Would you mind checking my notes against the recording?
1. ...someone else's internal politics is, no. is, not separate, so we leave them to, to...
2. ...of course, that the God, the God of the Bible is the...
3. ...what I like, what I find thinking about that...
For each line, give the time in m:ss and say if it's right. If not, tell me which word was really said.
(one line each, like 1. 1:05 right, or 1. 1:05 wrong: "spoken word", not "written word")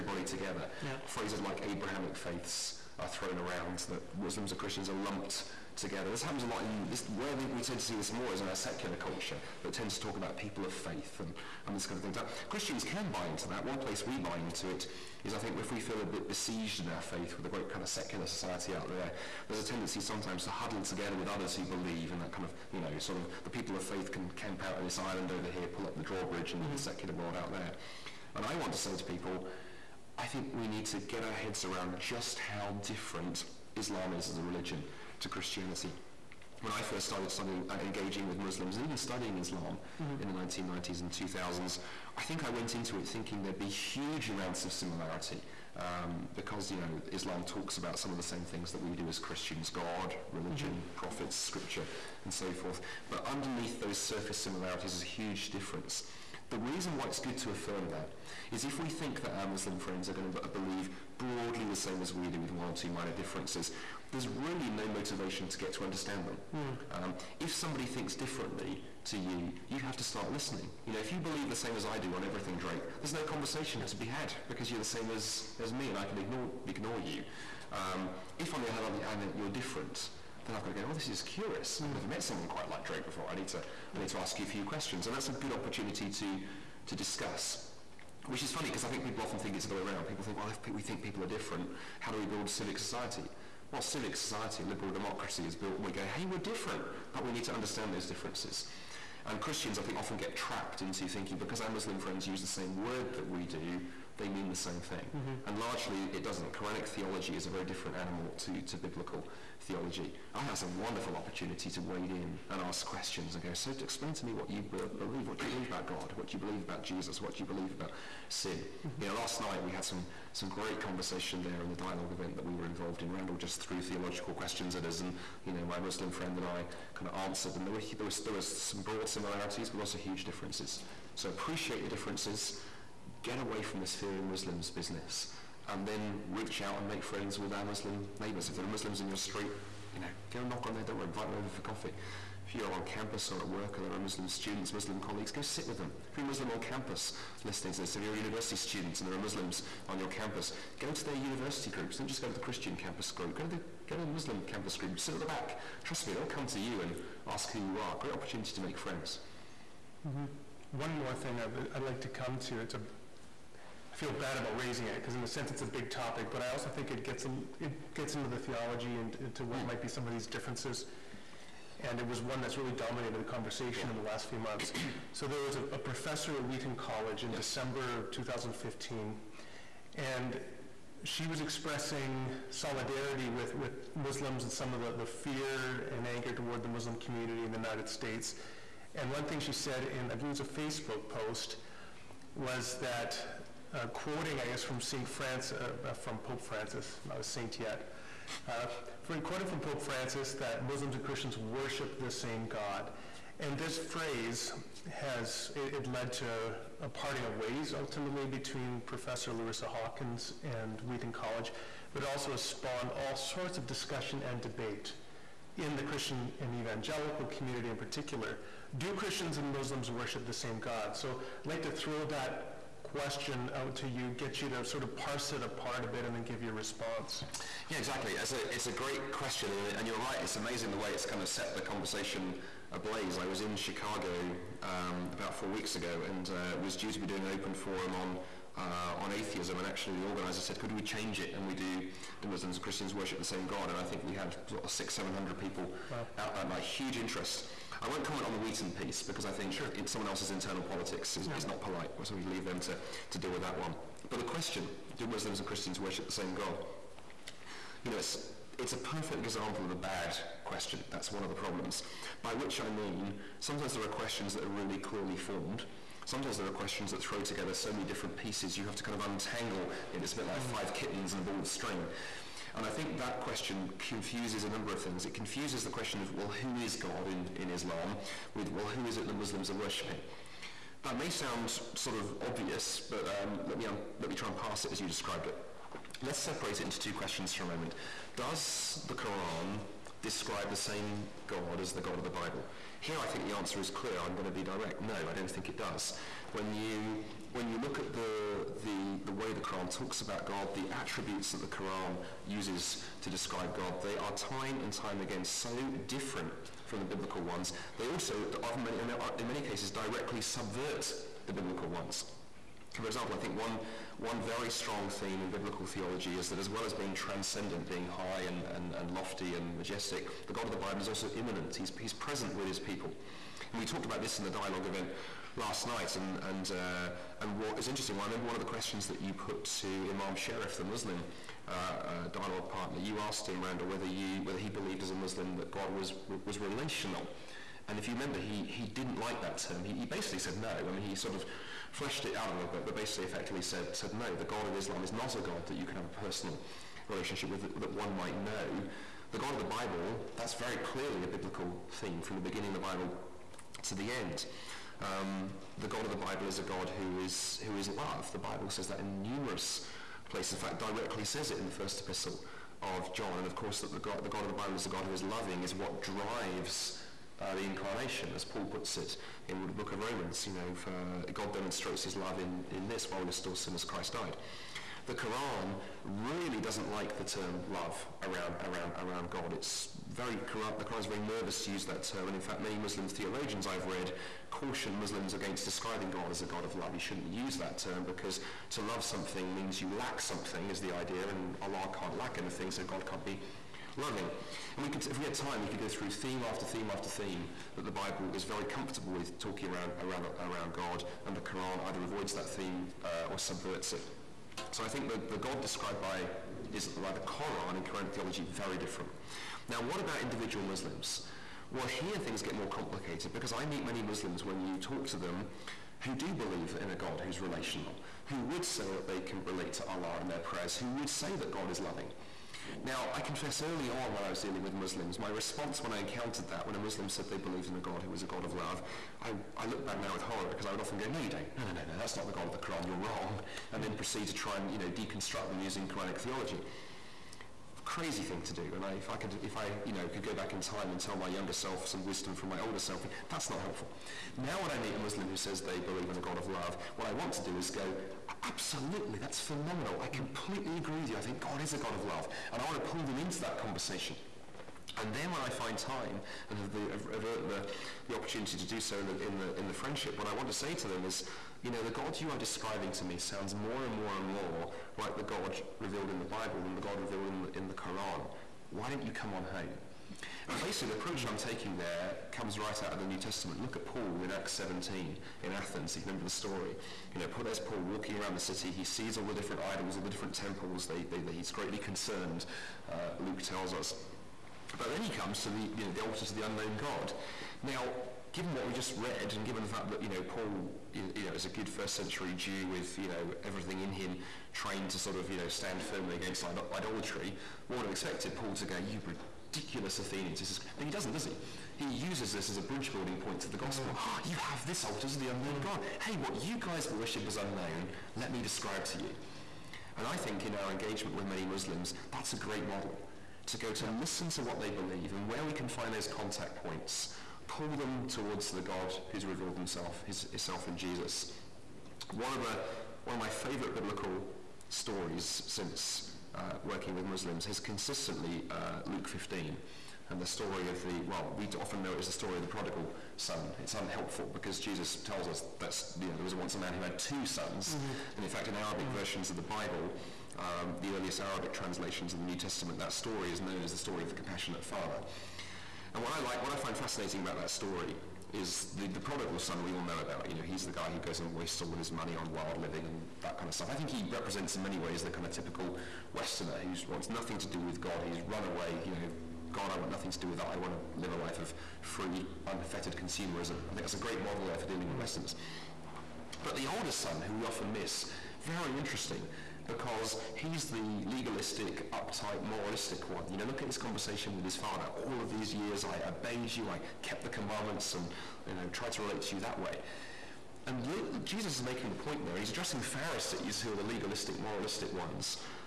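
1. 4:09 wrong: "polite", not "separate"
2. 6:03 right
3. 9:05 wrong: "fascinating", not "thinking".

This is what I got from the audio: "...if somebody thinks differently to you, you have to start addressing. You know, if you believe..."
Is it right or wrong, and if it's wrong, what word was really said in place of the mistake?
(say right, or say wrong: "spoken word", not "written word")
wrong: "listening", not "addressing".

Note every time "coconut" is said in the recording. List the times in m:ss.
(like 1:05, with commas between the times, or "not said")
not said.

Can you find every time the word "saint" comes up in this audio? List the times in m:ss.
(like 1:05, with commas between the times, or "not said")
3:17.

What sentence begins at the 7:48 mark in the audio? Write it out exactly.
Why don't you come on home?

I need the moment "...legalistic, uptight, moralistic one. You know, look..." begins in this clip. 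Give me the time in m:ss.
9:30.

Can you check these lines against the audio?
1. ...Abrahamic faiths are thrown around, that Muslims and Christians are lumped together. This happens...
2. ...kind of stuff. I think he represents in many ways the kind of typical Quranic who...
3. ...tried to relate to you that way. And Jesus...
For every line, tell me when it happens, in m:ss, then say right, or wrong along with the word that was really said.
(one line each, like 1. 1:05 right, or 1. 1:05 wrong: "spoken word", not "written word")
1. 0:01 right
2. 9:13 wrong: "Westerner", not "Quranic"
3. 9:38 right.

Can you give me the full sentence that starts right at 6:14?
The Quran really doesn't like the term love around, around, around God.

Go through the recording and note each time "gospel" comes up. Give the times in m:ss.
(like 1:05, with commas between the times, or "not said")
8:23.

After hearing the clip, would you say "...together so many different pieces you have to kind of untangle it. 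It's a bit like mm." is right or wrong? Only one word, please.
right.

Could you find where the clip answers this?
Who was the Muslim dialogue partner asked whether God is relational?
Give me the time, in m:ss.
5:29.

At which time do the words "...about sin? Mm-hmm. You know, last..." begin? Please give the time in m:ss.
1:57.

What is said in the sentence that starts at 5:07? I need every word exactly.
They also, many, uh, in many cases, directly subvert the biblical ones.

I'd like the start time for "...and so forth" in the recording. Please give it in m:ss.
0:52.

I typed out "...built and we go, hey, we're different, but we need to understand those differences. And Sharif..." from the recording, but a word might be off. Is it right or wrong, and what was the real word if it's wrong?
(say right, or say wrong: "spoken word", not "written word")
wrong: "Christians", not "Sharif".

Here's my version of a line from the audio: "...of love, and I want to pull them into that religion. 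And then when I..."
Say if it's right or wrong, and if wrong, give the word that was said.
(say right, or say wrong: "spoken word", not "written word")
wrong: "conversation", not "religion".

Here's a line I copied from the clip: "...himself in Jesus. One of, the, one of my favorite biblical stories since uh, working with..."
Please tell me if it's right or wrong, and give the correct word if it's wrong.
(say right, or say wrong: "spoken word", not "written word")
right.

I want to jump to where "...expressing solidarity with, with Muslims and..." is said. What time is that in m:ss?
3:01.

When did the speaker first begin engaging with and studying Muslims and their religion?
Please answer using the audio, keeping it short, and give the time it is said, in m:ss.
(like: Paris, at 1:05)
1990s and 2000s, at 0:40.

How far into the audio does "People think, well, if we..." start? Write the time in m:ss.
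1:30.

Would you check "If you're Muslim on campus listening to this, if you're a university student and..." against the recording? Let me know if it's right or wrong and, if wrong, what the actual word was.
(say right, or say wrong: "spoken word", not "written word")
right.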